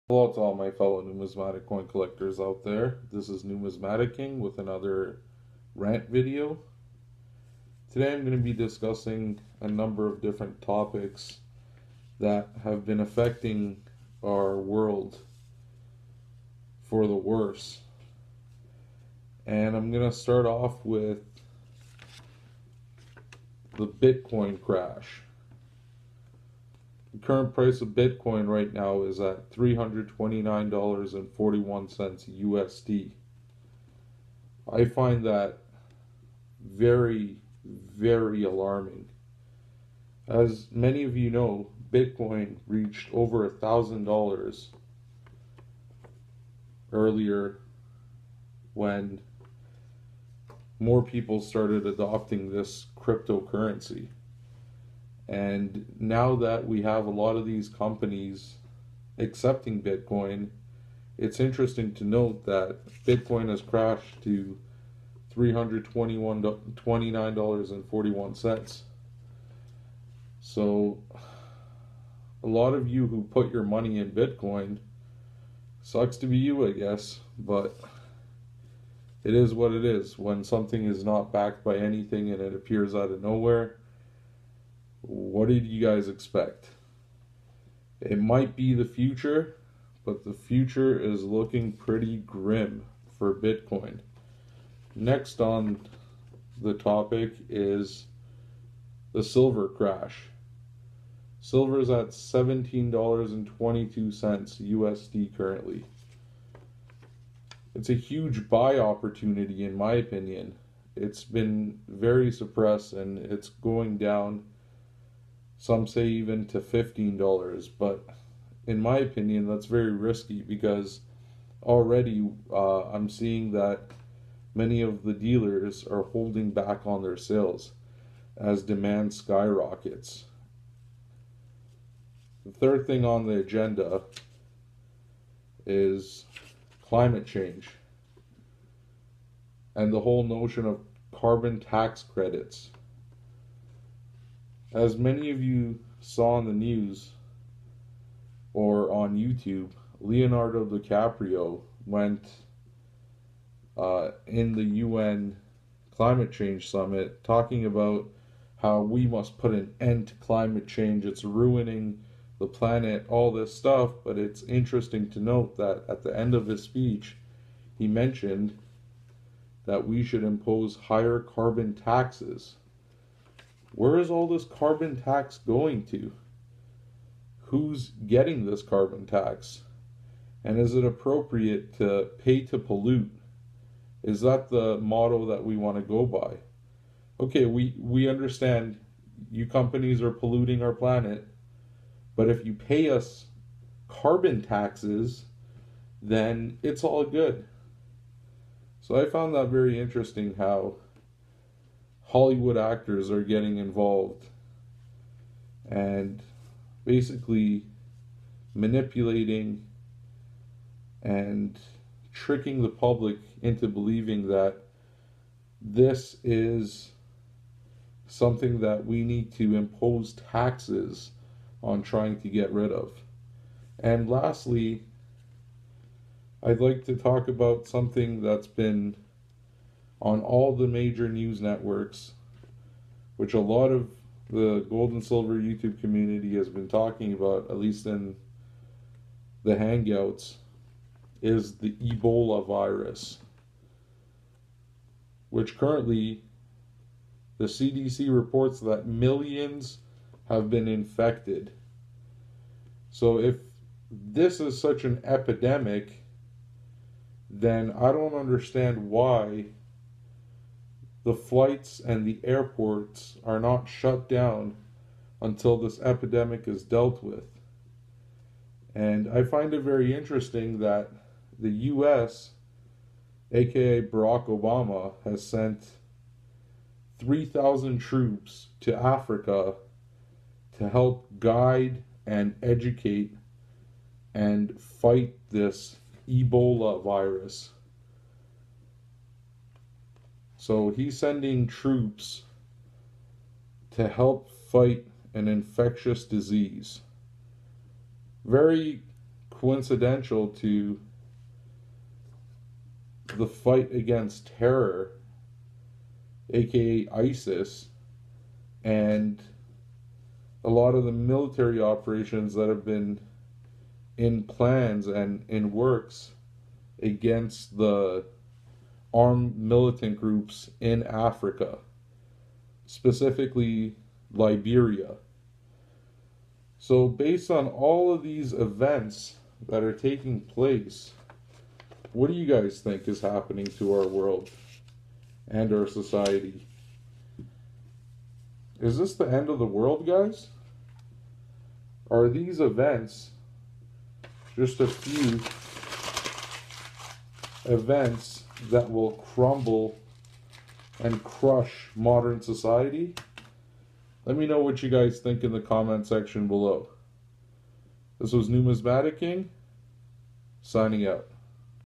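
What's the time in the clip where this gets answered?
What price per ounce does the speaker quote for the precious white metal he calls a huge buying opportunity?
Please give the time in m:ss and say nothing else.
1:42.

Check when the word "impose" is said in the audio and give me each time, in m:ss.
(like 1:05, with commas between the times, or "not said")
2:50, 3:39.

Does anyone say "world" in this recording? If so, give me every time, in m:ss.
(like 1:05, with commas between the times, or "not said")
0:14, 5:33, 5:39.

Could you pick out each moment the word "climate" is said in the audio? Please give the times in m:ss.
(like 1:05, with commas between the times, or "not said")
2:16, 2:35, 2:40.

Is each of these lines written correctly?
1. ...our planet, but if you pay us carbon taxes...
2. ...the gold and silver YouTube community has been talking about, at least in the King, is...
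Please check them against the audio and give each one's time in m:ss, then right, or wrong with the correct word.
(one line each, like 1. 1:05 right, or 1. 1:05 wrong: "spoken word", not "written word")
1. 3:10 right
2. 3:54 wrong: "Hangouts", not "King".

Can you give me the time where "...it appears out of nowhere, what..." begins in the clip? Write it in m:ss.
1:22.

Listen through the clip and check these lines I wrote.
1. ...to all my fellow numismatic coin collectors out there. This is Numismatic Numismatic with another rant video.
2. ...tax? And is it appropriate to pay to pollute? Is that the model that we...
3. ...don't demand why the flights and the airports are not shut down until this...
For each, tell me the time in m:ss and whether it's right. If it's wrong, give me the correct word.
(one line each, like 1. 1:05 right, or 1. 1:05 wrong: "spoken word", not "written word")
1. 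0:00 wrong: "King", not "Numismatic"
2. 2:59 right
3. 4:17 wrong: "understand", not "demand".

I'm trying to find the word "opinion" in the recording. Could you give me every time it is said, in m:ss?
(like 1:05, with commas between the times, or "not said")
1:49, 1:58.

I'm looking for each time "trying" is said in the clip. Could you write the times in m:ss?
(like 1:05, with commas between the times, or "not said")
3:41.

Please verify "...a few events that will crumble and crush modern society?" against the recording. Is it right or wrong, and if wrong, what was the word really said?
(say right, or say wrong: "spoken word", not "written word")
right.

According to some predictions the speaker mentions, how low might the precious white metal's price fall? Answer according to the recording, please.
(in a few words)
$15.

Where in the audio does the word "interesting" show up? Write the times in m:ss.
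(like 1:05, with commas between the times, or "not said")
1:01, 2:44, 3:19, 4:29.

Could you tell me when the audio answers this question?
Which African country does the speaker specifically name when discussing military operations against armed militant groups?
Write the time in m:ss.
5:24.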